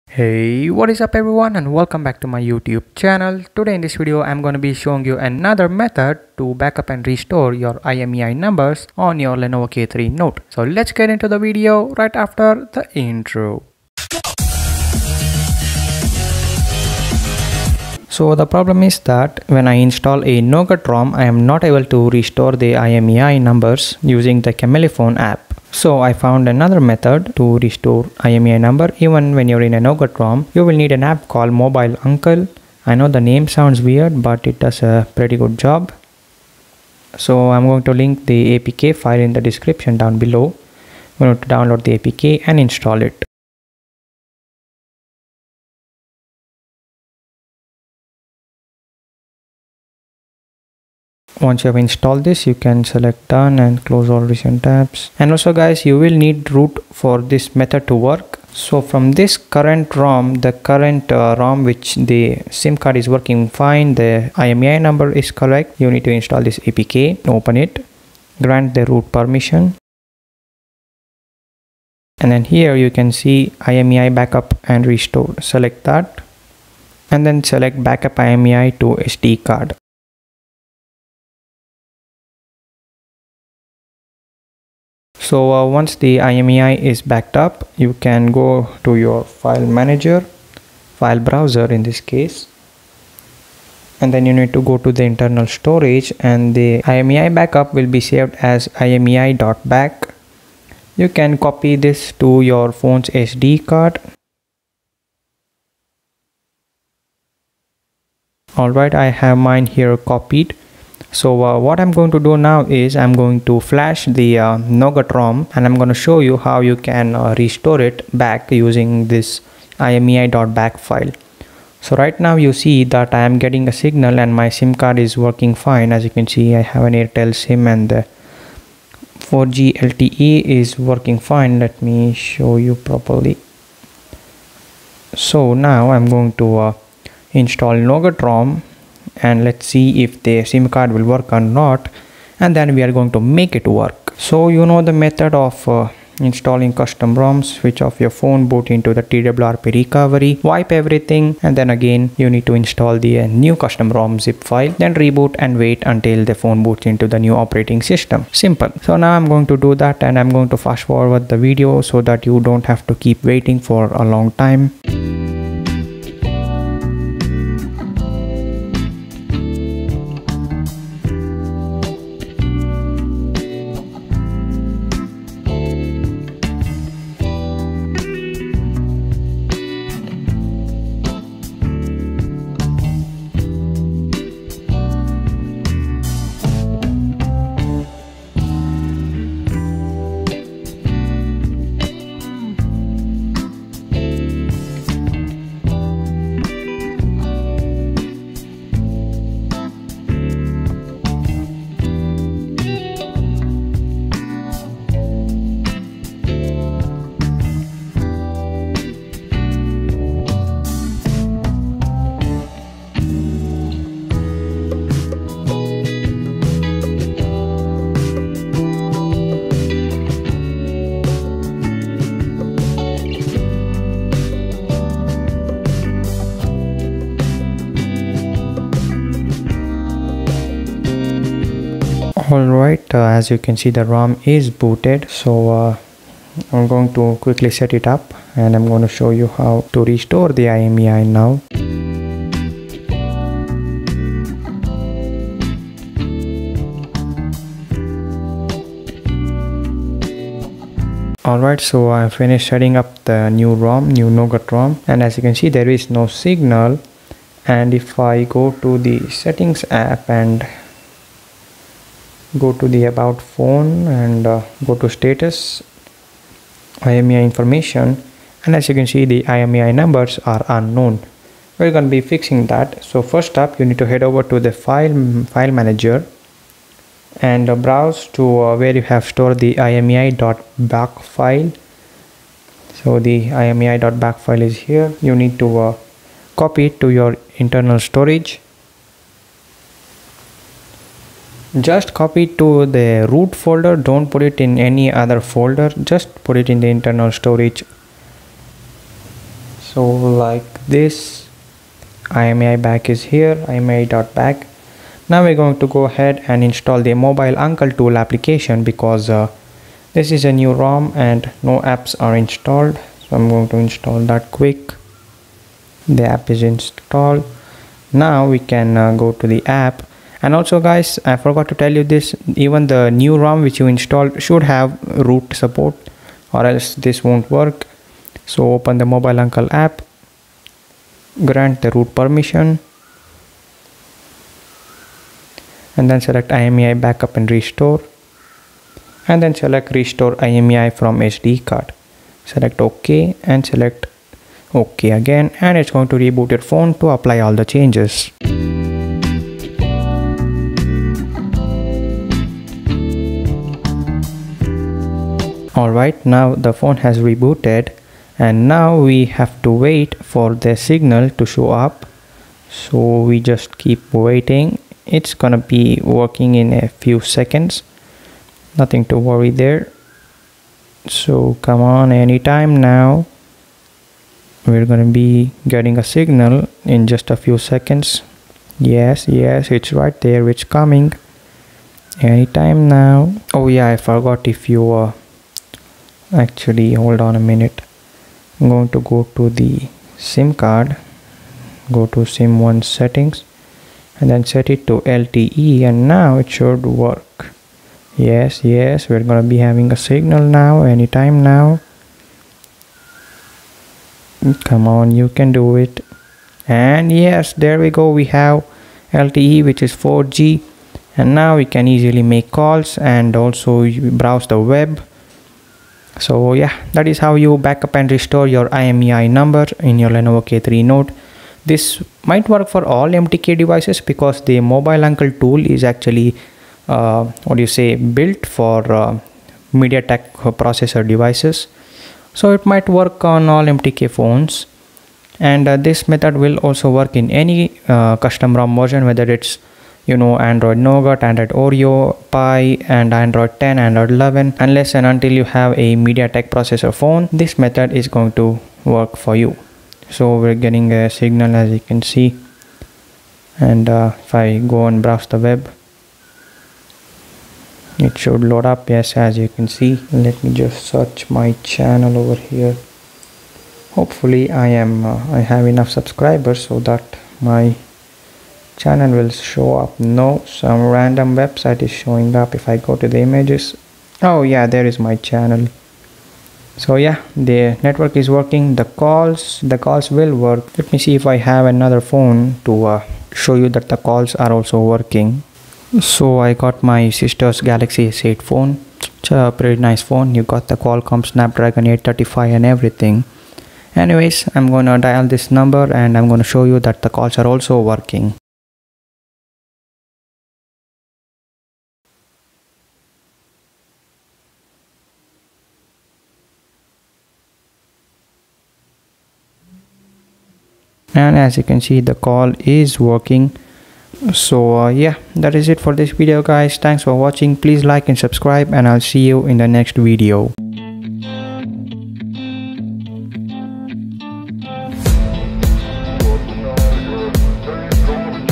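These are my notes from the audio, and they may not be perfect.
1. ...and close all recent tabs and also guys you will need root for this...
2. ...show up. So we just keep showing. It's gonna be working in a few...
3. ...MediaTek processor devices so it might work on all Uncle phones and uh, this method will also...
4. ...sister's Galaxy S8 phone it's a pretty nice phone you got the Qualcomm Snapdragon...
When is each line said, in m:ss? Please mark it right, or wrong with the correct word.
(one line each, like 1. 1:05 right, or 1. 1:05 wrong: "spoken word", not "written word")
1. 0:53 right
2. 6:01 wrong: "waiting", not "showing"
3. 7:09 wrong: "MTK", not "Uncle"
4. 8:06 right.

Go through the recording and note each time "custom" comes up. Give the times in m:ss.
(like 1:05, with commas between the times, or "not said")
2:26, 2:33, 7:17.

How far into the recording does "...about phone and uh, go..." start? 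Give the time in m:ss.
4:22.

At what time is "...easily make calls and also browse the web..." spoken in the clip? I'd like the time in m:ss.
6:51.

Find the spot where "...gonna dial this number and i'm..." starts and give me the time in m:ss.
8:14.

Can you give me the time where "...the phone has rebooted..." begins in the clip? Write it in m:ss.
5:56.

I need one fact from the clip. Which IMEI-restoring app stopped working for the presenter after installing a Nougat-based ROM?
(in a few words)
Chamelephon.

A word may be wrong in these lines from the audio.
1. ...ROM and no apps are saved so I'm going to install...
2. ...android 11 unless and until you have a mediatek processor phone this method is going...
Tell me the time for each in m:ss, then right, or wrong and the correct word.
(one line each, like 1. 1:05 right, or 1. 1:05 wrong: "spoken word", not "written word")
1. 5:10 wrong: "installed", not "saved"
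2. 7:23 right.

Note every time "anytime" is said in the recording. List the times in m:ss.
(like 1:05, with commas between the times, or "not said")
6:11, 6:22, 6:40.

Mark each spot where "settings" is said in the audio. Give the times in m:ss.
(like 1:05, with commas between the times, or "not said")
4:12, 4:19, 6:32.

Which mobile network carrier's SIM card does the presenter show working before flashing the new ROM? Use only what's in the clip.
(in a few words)
Airtel.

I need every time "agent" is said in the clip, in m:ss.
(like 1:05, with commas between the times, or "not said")
not said.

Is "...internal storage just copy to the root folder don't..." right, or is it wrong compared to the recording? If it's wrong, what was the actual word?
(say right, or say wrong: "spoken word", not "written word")
right.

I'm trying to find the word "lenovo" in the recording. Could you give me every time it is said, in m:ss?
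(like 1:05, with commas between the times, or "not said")
0:09, 6:59.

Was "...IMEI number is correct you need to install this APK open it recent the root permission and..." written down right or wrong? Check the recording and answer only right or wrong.
wrong.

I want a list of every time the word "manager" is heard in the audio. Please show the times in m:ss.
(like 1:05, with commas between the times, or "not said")
1:29, 4:35.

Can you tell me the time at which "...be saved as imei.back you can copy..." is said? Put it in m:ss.
1:37.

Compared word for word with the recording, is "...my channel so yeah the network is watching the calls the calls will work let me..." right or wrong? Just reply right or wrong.
wrong.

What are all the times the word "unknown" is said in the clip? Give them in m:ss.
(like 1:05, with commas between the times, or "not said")
4:30.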